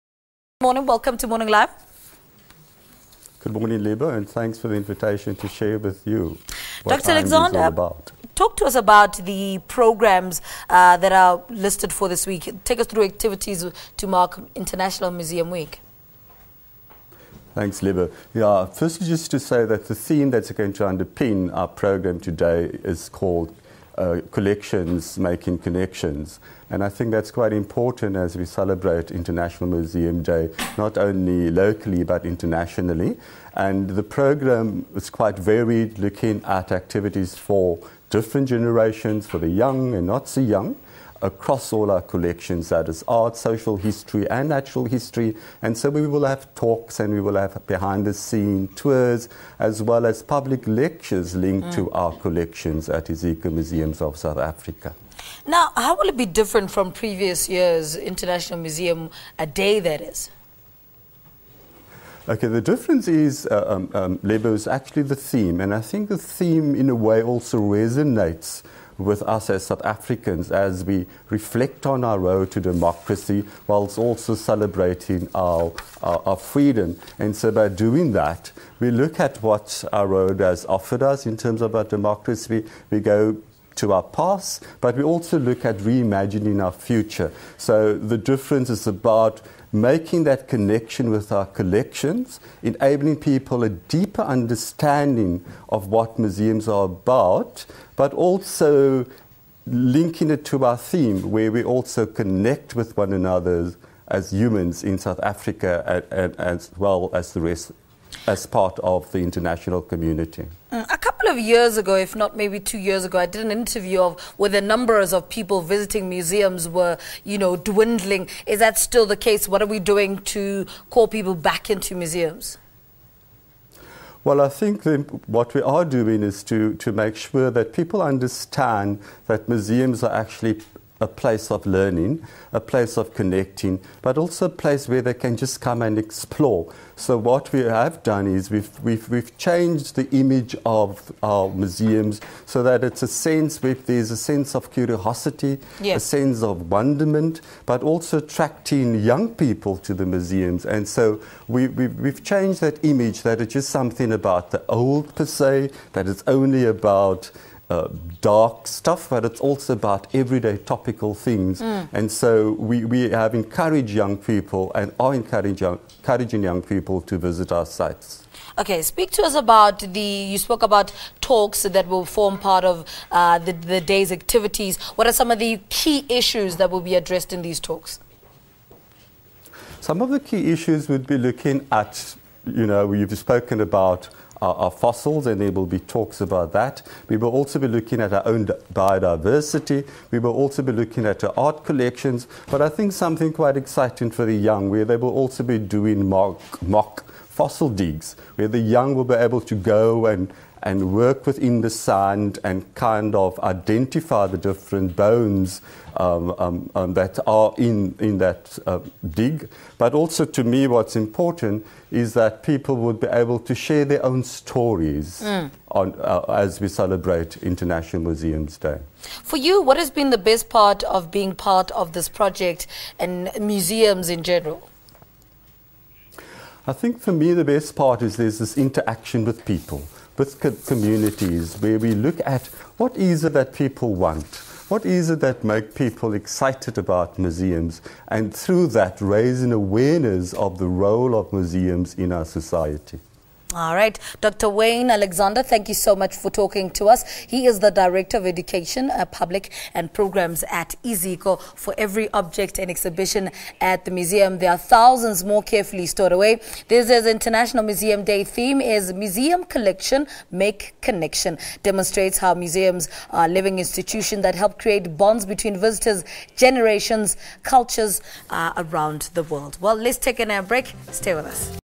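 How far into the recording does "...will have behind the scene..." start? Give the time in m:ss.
0:47.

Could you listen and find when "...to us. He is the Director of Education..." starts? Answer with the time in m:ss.
4:06.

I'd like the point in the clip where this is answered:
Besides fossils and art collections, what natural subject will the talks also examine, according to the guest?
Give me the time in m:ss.
3:08.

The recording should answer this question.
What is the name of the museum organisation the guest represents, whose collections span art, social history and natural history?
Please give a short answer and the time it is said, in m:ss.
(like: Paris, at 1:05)
Iziko Museums of South Africa, at 0:53.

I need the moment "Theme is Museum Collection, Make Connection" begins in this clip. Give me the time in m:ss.
4:18.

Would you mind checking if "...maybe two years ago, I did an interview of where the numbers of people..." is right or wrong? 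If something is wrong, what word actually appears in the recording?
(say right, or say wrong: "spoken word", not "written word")
right.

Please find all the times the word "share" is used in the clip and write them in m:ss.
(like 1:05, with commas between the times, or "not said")
0:05, 3:33.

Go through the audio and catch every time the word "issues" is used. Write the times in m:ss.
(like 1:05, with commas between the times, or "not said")
2:56, 3:00.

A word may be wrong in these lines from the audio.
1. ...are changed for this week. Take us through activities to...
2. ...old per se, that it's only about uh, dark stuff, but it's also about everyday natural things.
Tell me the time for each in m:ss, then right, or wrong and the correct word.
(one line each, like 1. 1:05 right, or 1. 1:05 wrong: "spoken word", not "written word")
1. 0:11 wrong: "listed", not "changed"
2. 2:34 wrong: "topical", not "natural".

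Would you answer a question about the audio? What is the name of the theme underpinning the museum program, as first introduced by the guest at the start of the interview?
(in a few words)
Collections making connections.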